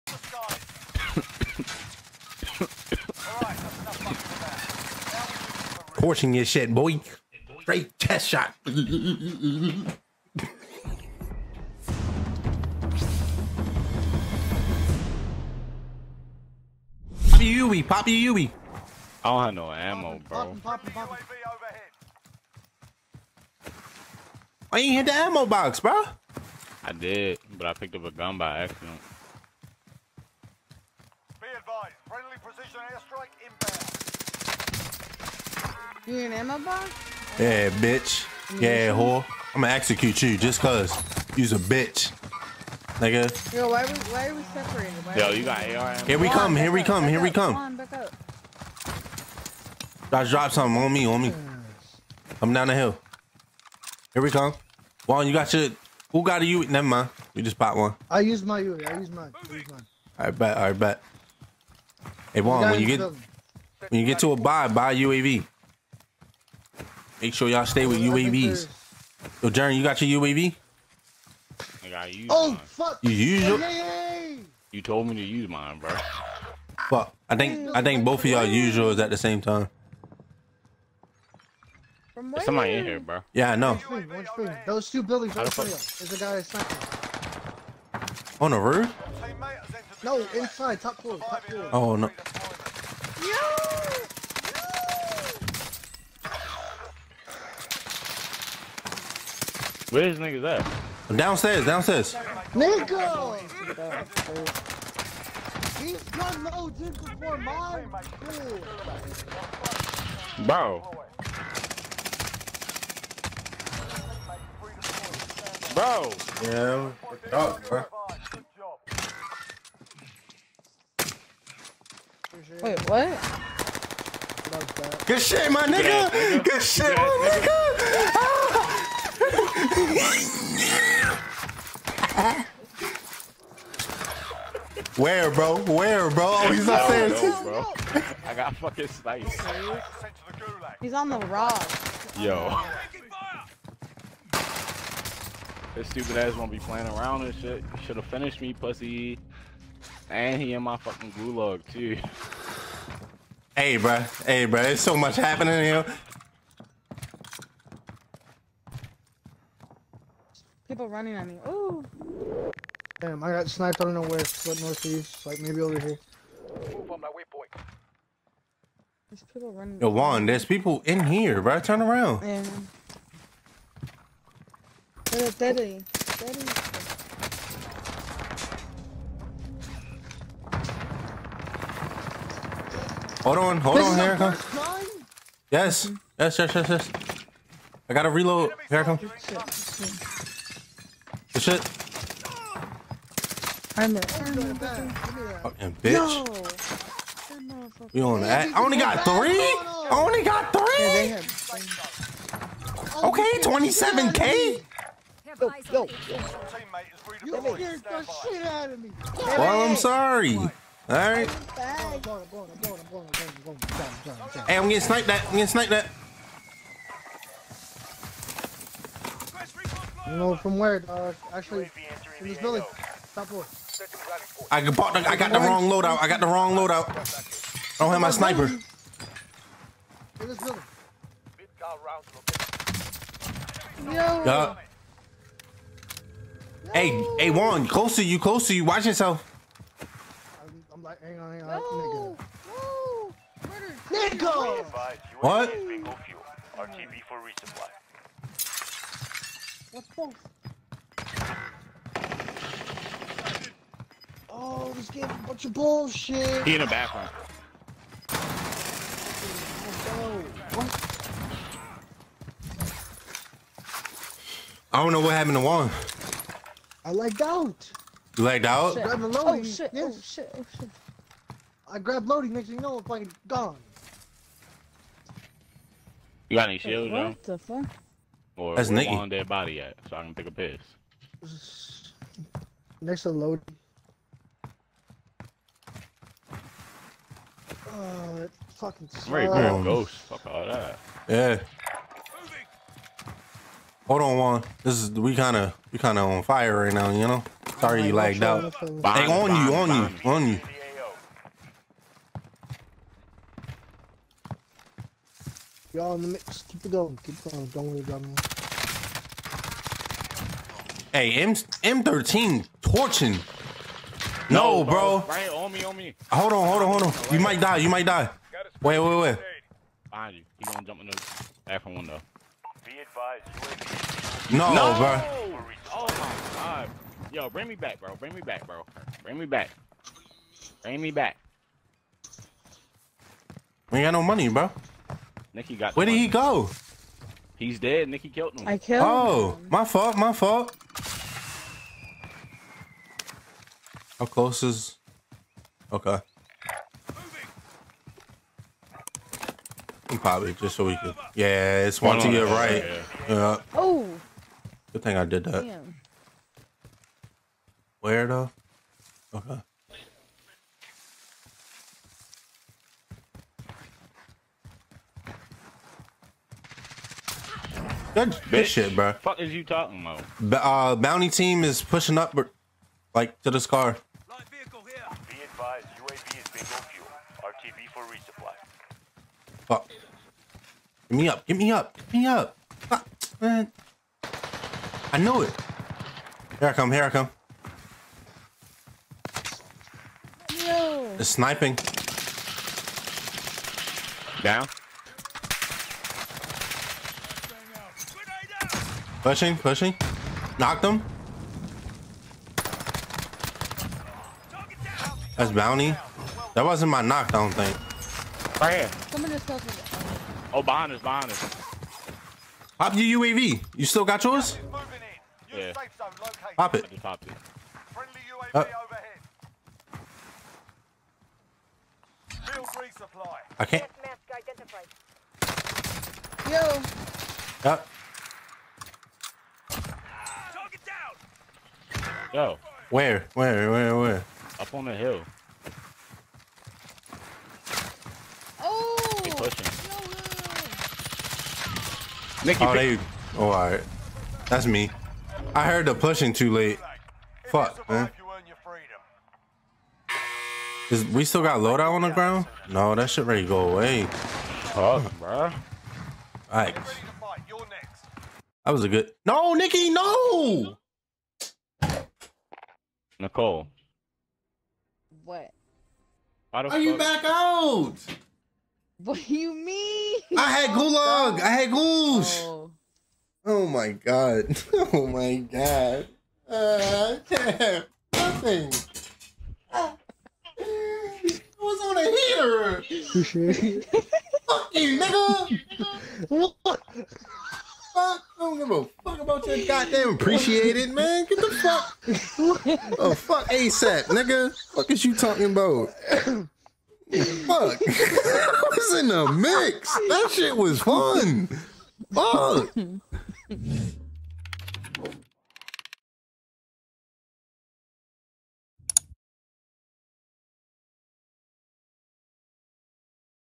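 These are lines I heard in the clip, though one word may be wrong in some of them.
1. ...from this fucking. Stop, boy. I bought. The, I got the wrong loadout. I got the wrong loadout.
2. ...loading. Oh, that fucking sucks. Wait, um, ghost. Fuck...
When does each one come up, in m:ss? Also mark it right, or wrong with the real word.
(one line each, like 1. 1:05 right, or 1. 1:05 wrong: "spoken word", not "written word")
1. 3:42 wrong: "building", not "fucking"
2. 4:43 right.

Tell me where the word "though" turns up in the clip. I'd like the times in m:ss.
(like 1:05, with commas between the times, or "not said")
4:37, 5:58.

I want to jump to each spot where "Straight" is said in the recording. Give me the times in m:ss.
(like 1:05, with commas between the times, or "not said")
0:07.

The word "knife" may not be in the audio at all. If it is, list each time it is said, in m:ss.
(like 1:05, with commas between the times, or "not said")
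not said.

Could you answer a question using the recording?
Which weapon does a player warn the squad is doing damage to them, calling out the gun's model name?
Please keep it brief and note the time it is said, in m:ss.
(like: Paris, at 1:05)
M13, at 5:11.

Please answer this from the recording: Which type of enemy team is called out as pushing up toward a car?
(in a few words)
Bounty team.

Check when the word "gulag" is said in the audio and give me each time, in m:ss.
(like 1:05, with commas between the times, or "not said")
2:31, 7:50.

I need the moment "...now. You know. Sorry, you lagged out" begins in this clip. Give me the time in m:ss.
4:56.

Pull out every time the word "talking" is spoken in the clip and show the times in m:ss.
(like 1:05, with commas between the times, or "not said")
6:09, 8:14.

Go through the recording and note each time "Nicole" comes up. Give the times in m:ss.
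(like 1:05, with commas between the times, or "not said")
7:42.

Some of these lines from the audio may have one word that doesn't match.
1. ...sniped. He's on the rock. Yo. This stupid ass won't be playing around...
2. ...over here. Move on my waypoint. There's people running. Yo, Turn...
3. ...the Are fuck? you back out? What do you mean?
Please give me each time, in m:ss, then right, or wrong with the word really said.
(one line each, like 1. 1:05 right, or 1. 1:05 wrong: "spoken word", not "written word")
1. 2:18 right
2. 2:45 wrong: "Juan", not "Turn"
3. 7:46 right.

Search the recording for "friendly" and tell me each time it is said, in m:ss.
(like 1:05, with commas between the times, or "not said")
0:32, 6:57.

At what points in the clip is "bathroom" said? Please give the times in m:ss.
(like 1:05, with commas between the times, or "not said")
4:16, 5:21.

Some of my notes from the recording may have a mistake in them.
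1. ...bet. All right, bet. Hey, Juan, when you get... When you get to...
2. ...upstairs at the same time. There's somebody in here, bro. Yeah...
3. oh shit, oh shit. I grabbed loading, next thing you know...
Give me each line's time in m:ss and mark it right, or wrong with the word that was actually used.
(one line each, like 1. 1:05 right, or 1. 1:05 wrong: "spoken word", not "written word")
1. 1:00 right
2. 1:18 wrong: "yours", not "upstairs"
3. 4:29 right.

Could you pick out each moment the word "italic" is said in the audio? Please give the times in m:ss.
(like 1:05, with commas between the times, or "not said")
not said.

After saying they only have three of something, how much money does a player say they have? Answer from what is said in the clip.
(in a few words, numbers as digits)
27k.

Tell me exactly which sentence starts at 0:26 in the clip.
I did, but I picked up a gun by accident.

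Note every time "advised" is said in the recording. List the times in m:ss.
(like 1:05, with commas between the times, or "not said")
0:31, 5:22.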